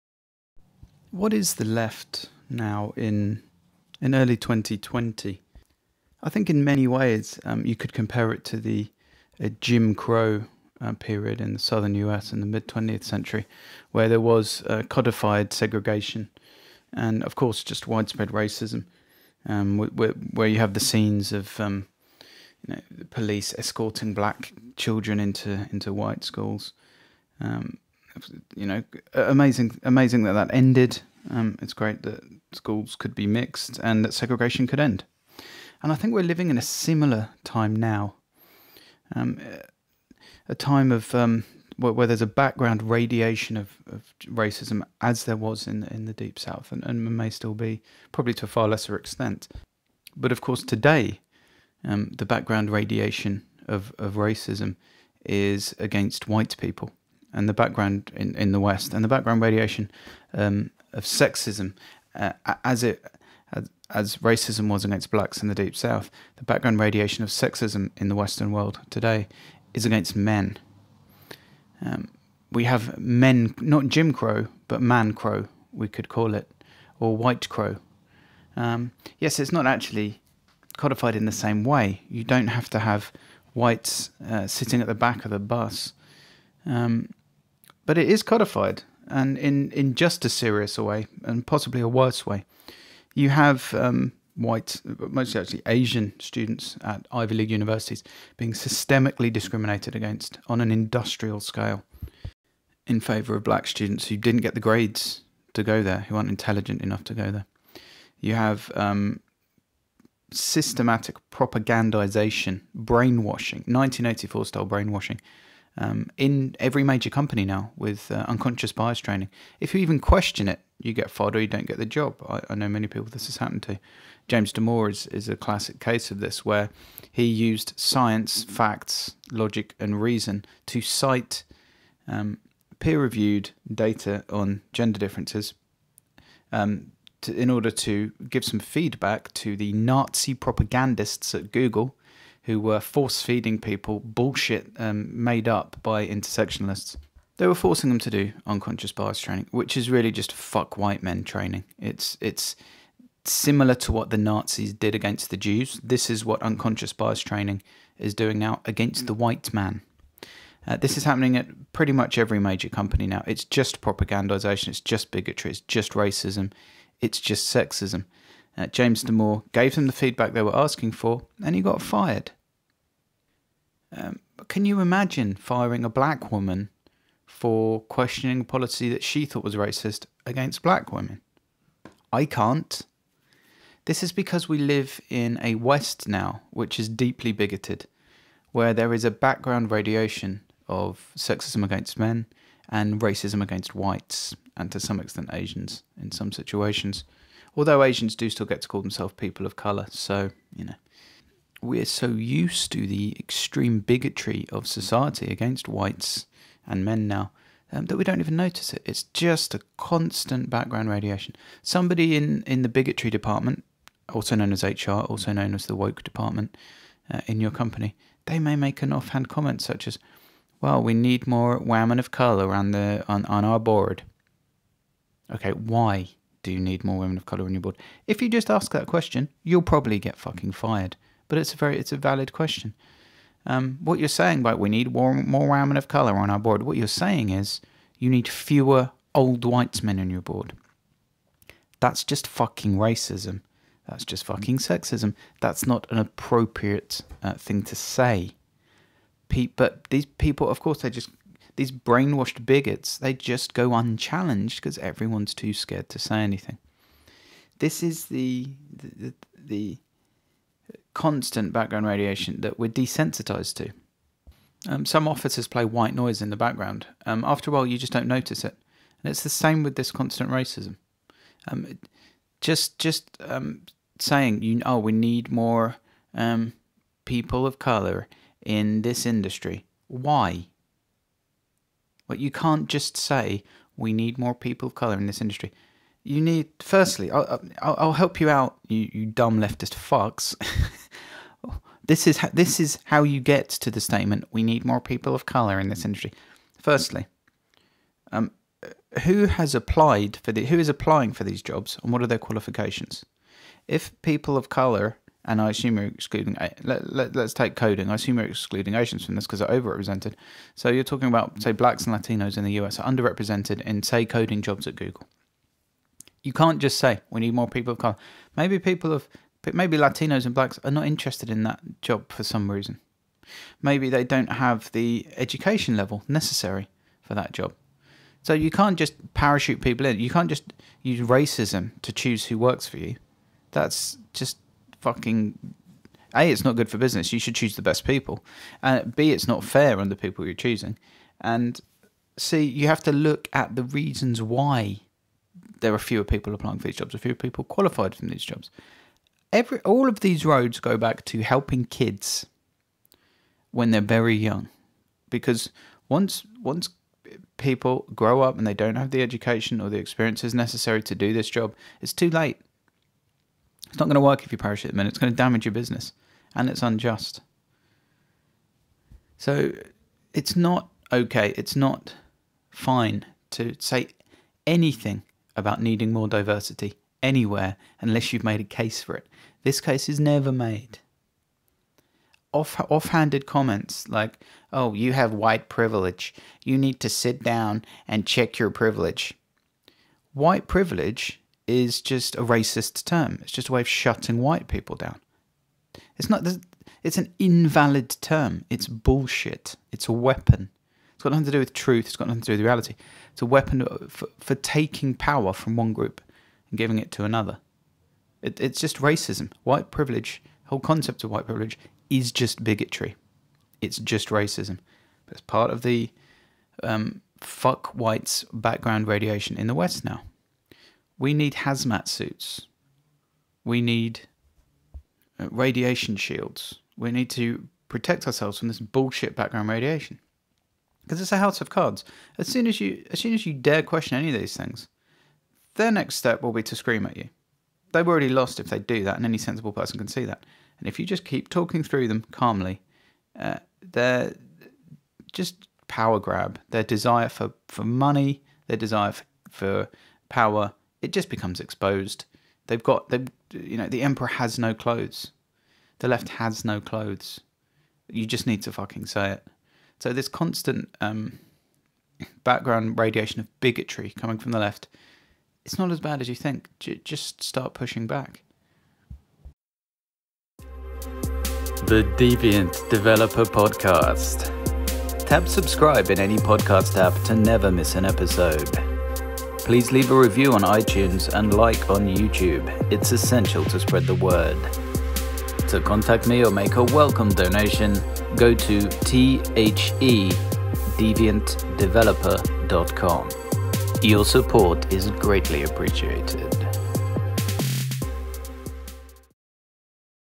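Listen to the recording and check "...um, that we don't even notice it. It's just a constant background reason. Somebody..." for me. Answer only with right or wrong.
wrong.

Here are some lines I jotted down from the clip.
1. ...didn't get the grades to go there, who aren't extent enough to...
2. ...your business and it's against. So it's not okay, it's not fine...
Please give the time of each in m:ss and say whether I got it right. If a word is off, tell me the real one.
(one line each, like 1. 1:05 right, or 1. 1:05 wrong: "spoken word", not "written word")
1. 1:44 wrong: "intelligent", not "extent"
2. 6:05 wrong: "unjust", not "against".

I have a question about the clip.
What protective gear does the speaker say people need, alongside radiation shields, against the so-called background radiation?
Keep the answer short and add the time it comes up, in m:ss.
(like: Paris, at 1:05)
hazmat suits, at 7:01.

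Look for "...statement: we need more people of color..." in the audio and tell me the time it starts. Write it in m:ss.
4:53.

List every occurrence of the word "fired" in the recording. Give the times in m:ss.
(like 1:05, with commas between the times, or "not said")
2:01, 2:51, 3:50.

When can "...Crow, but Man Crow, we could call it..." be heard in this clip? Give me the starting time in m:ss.
1:14.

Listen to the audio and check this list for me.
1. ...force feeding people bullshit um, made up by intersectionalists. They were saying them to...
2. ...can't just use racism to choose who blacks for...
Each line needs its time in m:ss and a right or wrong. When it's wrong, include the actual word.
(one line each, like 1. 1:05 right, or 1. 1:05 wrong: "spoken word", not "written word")
1. 2:22 wrong: "forcing", not "saying"
2. 5:30 wrong: "works", not "blacks".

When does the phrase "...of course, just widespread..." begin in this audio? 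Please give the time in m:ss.
0:17.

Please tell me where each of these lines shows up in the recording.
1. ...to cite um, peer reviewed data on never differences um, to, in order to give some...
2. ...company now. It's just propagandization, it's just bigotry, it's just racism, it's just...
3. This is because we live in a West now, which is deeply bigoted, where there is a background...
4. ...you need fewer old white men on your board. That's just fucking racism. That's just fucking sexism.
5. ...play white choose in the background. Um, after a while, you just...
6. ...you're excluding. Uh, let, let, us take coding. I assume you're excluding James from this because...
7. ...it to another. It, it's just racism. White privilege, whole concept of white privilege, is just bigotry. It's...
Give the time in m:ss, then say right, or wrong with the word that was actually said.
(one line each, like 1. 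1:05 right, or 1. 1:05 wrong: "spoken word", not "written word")
1. 2:10 wrong: "gender", not "never"
2. 2:42 right
3. 3:03 right
4. 3:57 right
5. 4:25 wrong: "noise", not "choose"
6. 5:05 wrong: "Asians", not "James"
7. 6:46 right.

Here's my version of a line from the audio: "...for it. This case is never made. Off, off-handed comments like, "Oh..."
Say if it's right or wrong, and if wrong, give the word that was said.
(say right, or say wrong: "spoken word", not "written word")
right.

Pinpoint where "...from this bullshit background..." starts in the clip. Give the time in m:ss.
7:08.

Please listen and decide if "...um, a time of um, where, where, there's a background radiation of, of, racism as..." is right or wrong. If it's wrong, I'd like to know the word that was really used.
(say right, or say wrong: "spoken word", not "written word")
right.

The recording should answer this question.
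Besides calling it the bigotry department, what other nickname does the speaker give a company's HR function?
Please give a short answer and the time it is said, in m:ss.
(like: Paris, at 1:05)
the woke department, at 3:35.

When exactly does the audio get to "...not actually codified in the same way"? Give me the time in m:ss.
1:19.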